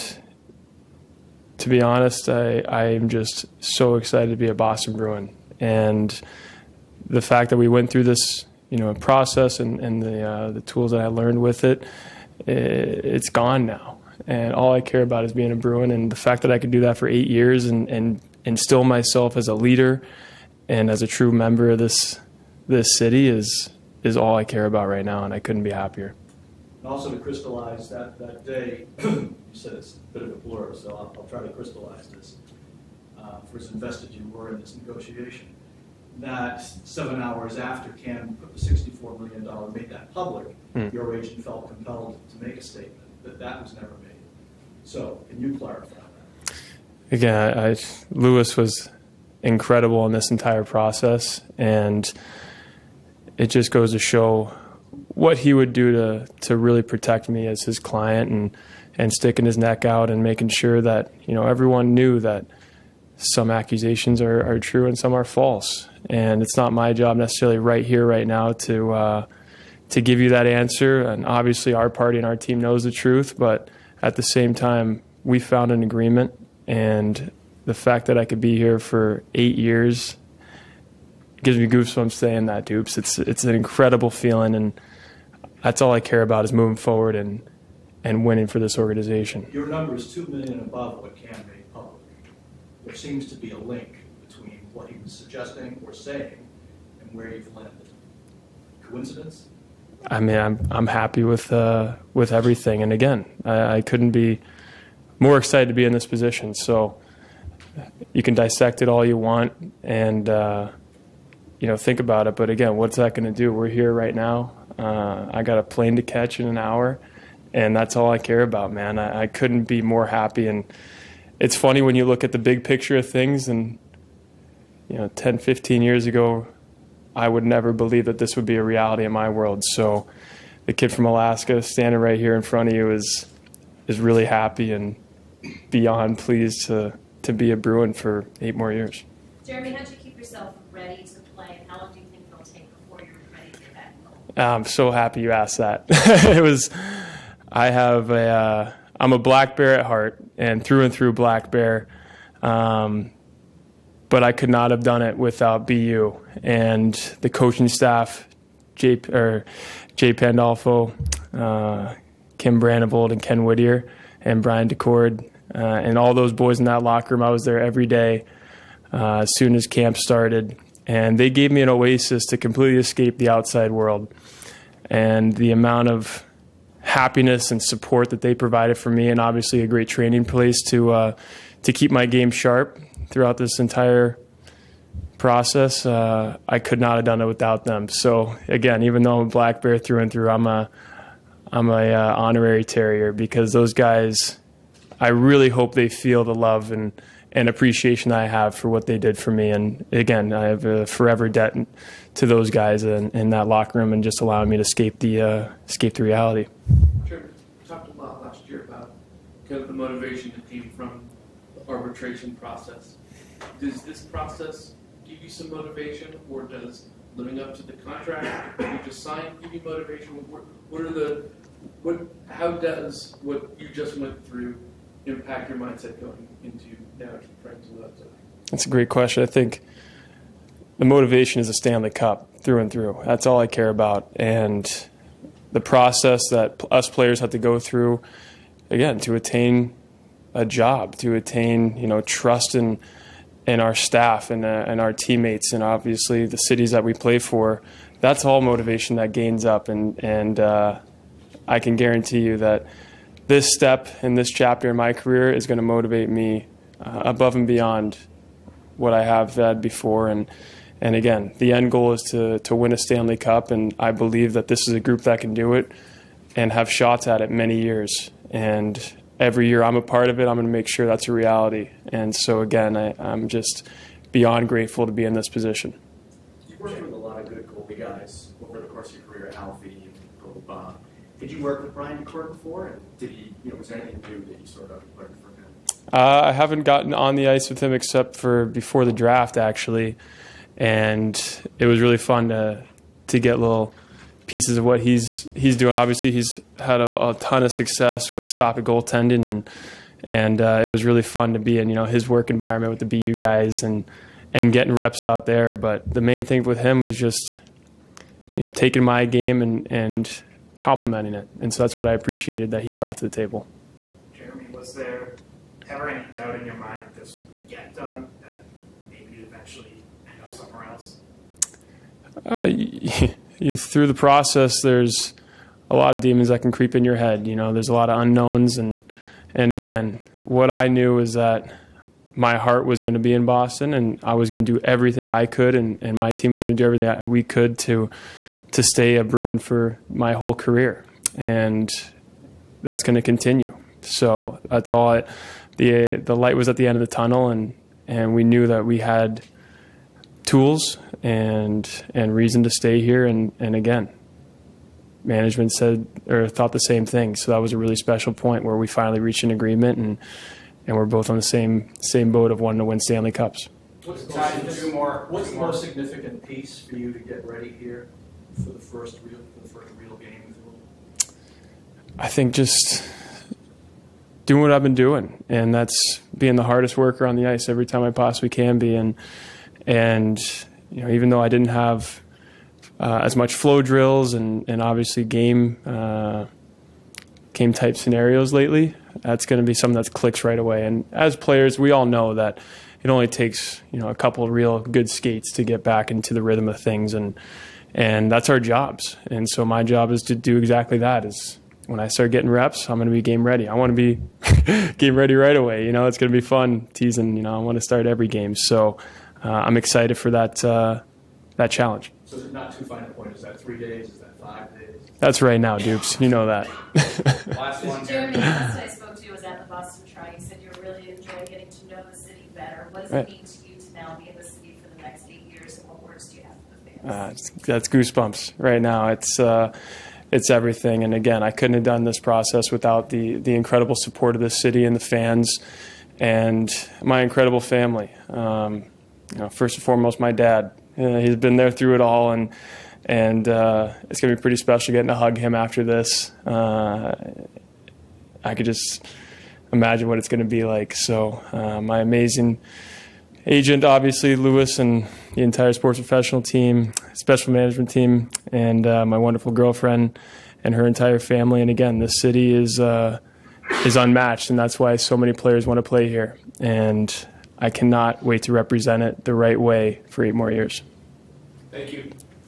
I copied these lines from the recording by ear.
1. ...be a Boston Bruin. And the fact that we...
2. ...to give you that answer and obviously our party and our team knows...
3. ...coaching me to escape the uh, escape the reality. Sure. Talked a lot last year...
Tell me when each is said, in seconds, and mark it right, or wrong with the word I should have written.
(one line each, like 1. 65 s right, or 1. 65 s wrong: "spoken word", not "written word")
1. 4 s right
2. 69 s right
3. 204 s wrong: "allowing", not "coaching".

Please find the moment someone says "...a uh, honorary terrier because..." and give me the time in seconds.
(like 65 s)
191 s.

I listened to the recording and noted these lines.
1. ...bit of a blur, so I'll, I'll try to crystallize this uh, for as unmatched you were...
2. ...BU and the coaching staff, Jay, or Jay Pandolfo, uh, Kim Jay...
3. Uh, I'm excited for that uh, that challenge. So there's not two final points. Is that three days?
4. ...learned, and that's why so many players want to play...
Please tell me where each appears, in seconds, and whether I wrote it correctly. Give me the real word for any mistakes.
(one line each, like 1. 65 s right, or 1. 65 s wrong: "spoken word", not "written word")
1. 30 s wrong: "invested", not "unmatched"
2. 155 s wrong: "Brandvold", not "Jay"
3. 409 s right
4. 463 s wrong: "unmatched", not "learned".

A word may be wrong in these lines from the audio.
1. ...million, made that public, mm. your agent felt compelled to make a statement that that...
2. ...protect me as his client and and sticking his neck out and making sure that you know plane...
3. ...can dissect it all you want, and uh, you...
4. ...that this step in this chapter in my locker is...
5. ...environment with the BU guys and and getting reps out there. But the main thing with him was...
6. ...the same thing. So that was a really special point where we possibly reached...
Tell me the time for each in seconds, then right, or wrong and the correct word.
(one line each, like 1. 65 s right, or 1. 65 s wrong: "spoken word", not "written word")
1. 39 s right
2. 56 s wrong: "everyone", not "plane"
3. 108 s right
4. 252 s wrong: "career", not "locker"
5. 302 s right
6. 356 s wrong: "finally", not "possibly".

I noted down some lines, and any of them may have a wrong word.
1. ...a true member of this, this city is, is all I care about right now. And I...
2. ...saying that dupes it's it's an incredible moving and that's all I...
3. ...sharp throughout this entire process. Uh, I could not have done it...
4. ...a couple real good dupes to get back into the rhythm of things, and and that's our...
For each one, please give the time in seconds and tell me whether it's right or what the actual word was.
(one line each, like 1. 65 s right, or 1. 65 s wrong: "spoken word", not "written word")
1. 21 s right
2. 82 s wrong: "feeling", not "moving"
3. 182 s right
4. 393 s wrong: "skates", not "dupes".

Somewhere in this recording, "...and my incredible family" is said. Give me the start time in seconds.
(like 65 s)
435 s.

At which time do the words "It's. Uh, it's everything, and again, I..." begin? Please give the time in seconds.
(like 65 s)
428 s.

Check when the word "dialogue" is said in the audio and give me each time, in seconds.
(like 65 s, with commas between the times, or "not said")
not said.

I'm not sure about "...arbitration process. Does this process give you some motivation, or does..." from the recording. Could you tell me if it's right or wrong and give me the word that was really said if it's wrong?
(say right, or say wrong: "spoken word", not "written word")
right.